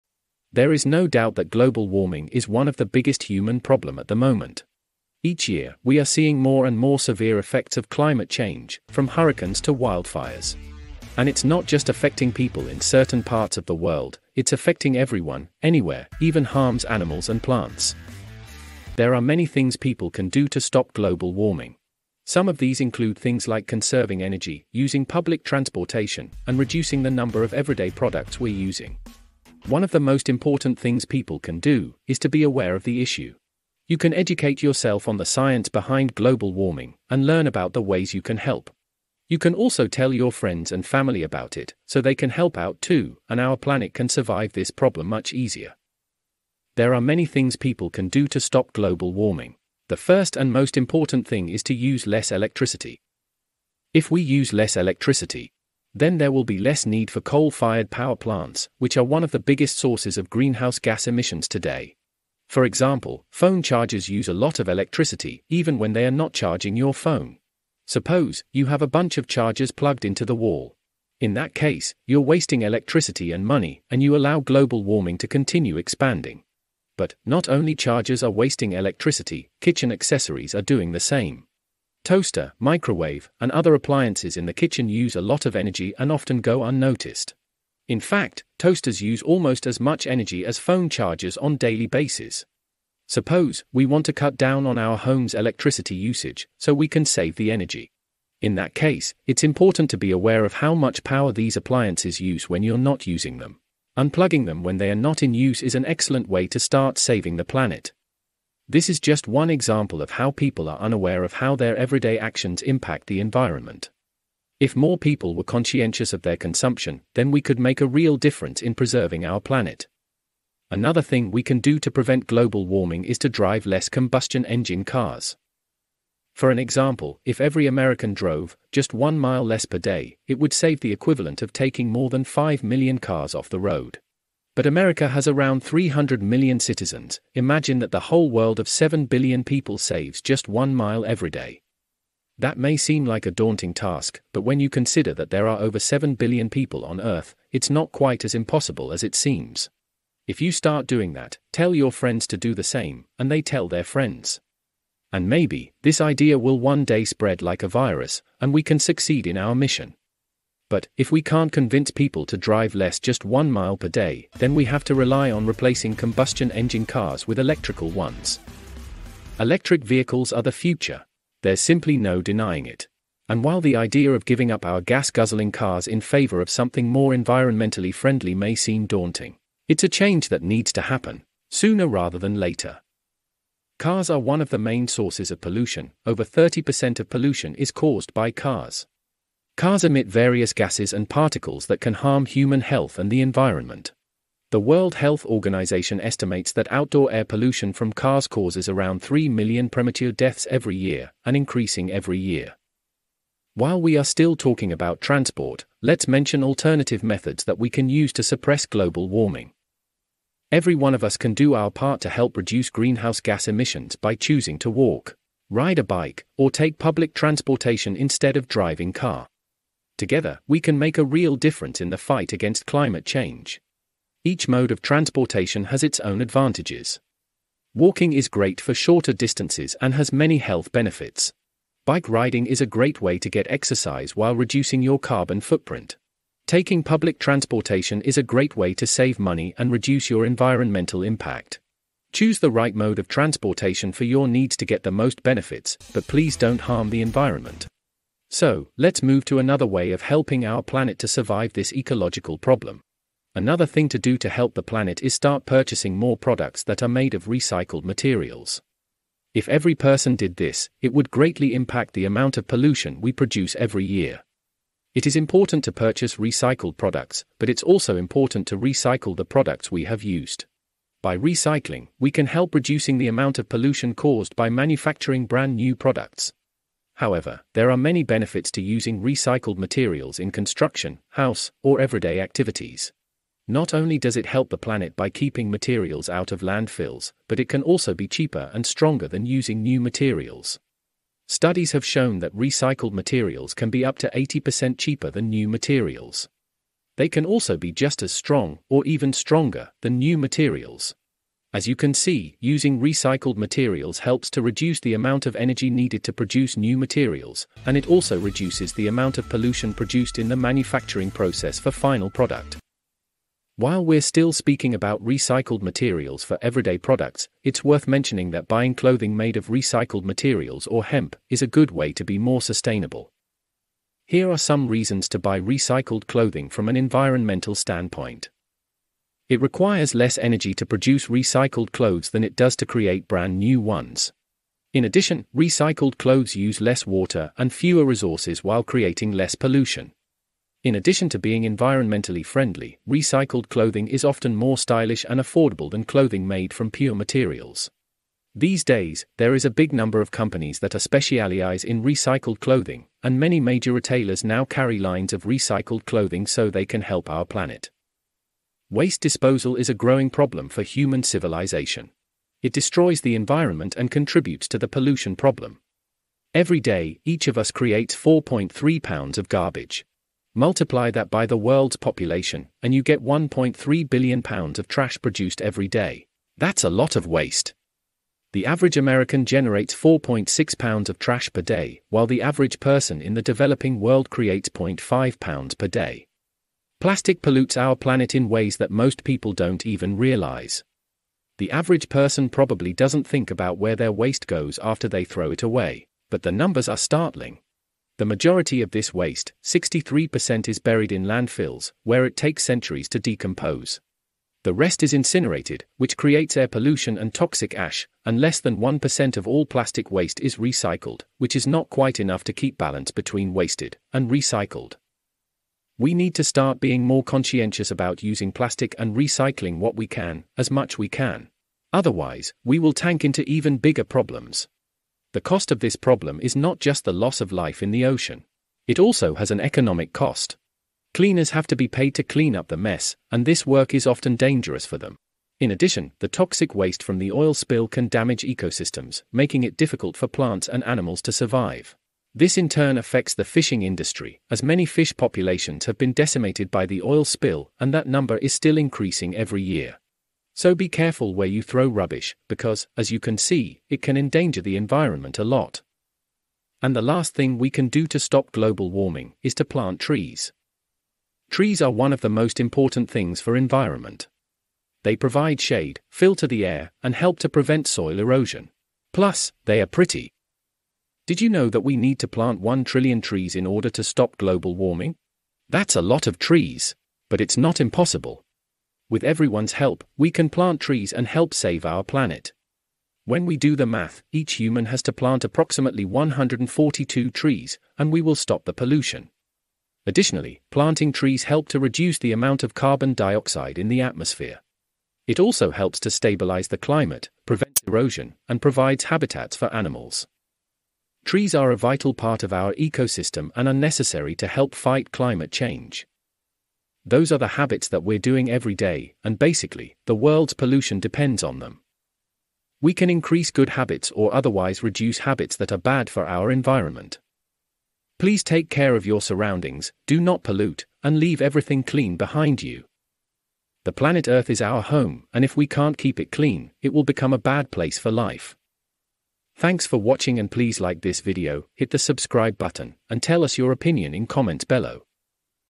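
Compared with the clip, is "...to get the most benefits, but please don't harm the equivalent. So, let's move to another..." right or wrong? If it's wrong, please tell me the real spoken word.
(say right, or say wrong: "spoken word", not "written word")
wrong: "environment", not "equivalent".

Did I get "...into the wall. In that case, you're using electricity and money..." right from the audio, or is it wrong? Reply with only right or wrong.
wrong.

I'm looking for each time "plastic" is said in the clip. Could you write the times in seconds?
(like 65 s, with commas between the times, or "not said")
386 s, 409 s, 418 s.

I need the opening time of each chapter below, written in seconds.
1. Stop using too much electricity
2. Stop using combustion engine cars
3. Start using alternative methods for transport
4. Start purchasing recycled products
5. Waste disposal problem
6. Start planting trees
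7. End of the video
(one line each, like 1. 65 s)
1. 50 s
2. 121 s
3. 204 s
4. 248 s
5. 359 s
6. 456 s
7. 507 s.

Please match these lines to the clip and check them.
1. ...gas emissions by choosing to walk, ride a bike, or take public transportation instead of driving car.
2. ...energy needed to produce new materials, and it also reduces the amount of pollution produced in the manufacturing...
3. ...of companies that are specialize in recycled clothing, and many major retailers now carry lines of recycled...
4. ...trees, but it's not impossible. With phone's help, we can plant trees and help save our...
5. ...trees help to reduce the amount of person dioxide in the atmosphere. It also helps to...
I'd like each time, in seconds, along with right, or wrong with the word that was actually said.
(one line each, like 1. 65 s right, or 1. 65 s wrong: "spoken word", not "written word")
1. 213 s right
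2. 305 s right
3. 350 s right
4. 476 s wrong: "everyone", not "phone"
5. 490 s wrong: "carbon", not "person".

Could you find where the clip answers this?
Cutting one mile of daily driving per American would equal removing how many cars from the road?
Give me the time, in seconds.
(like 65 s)
131 s.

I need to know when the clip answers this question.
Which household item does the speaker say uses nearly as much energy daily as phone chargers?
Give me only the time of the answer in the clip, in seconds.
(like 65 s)
88 s.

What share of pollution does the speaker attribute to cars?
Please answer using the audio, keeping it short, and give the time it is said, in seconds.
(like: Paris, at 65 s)
over 30%, at 186 s.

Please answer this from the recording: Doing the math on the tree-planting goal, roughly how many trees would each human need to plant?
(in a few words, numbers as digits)
142.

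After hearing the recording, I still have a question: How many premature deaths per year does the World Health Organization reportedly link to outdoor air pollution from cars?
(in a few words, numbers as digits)
around 3 million.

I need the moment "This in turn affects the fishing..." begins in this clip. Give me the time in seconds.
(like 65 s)
442 s.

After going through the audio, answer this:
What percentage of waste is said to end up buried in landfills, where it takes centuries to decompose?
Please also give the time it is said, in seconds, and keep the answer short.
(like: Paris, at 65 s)
63%, at 399 s.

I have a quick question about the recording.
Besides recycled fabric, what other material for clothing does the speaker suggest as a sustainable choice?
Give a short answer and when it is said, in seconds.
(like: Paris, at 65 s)
Hemp, at 320 s.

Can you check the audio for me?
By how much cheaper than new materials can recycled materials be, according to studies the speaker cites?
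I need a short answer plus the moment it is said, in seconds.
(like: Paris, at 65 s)
up to 80%, at 293 s.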